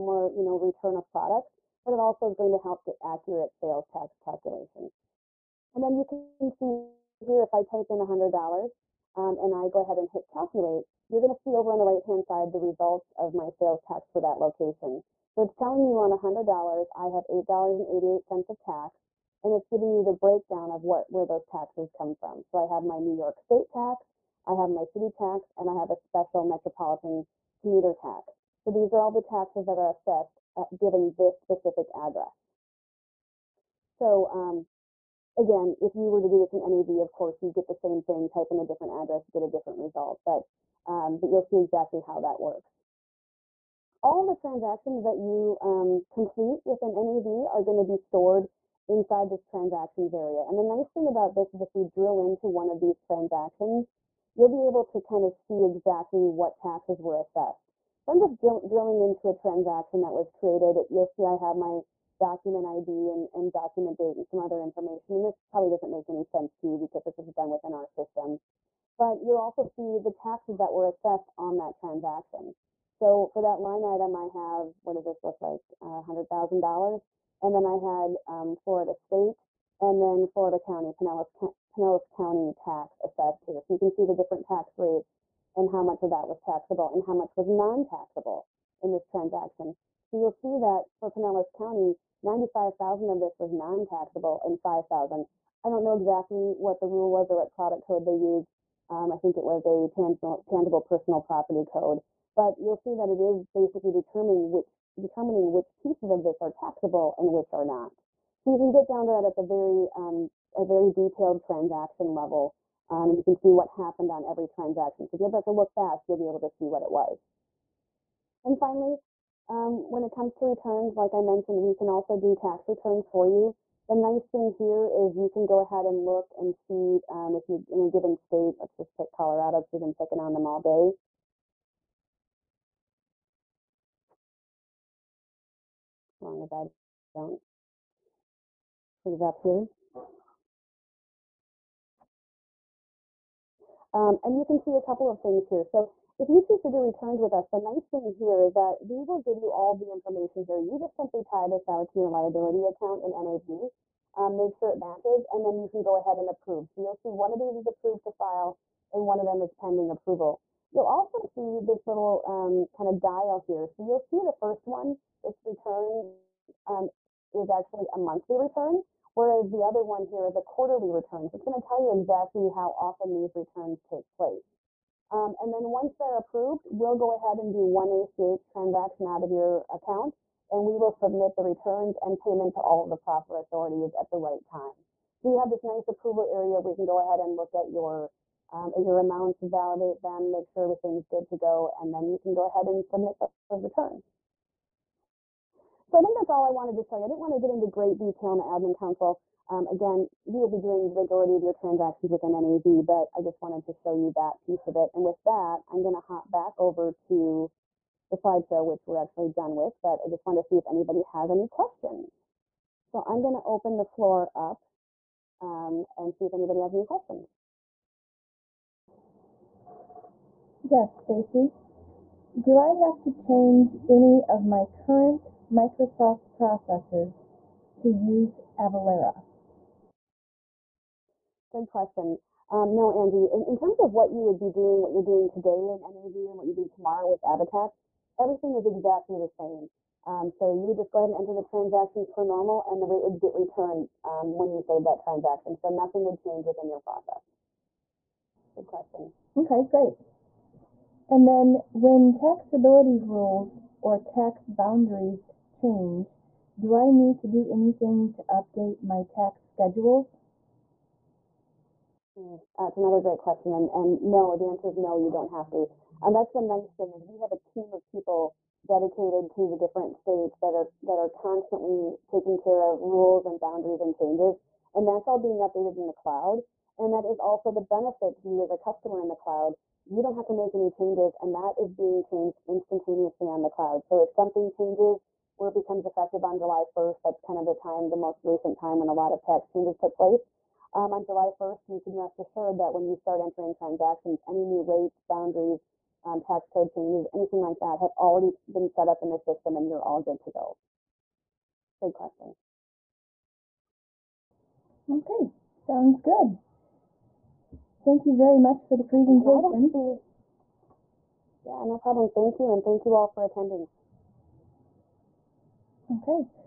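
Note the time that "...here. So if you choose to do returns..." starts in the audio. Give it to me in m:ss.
2:25.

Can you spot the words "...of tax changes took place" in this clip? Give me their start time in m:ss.
4:49.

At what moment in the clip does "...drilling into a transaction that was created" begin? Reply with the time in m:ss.
0:58.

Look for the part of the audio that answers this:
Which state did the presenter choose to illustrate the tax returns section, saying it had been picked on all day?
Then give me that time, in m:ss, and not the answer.
2:09.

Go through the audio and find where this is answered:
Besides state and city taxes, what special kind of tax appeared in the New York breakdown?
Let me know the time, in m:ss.
0:26.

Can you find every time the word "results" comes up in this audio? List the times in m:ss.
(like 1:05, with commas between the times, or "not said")
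0:12, 0:39.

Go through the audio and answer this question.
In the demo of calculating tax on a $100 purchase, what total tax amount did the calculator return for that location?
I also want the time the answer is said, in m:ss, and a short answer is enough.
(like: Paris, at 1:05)
$8.88, at 0:17.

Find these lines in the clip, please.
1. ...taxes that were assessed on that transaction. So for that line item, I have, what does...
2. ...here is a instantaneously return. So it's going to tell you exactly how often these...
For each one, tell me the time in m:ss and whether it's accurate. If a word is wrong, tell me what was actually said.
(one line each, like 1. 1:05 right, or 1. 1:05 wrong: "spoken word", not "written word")
1. 1:10 right
2. 2:50 wrong: "quarterly", not "instantaneously".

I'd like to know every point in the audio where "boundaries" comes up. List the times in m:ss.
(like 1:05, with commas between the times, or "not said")
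4:14, 4:33, 4:55.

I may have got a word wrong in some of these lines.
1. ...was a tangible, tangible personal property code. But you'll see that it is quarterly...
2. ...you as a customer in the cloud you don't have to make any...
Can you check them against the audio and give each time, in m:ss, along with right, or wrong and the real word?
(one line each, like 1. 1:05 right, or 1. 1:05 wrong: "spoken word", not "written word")
1. 1:39 wrong: "basically", not "quarterly"
2. 4:38 right.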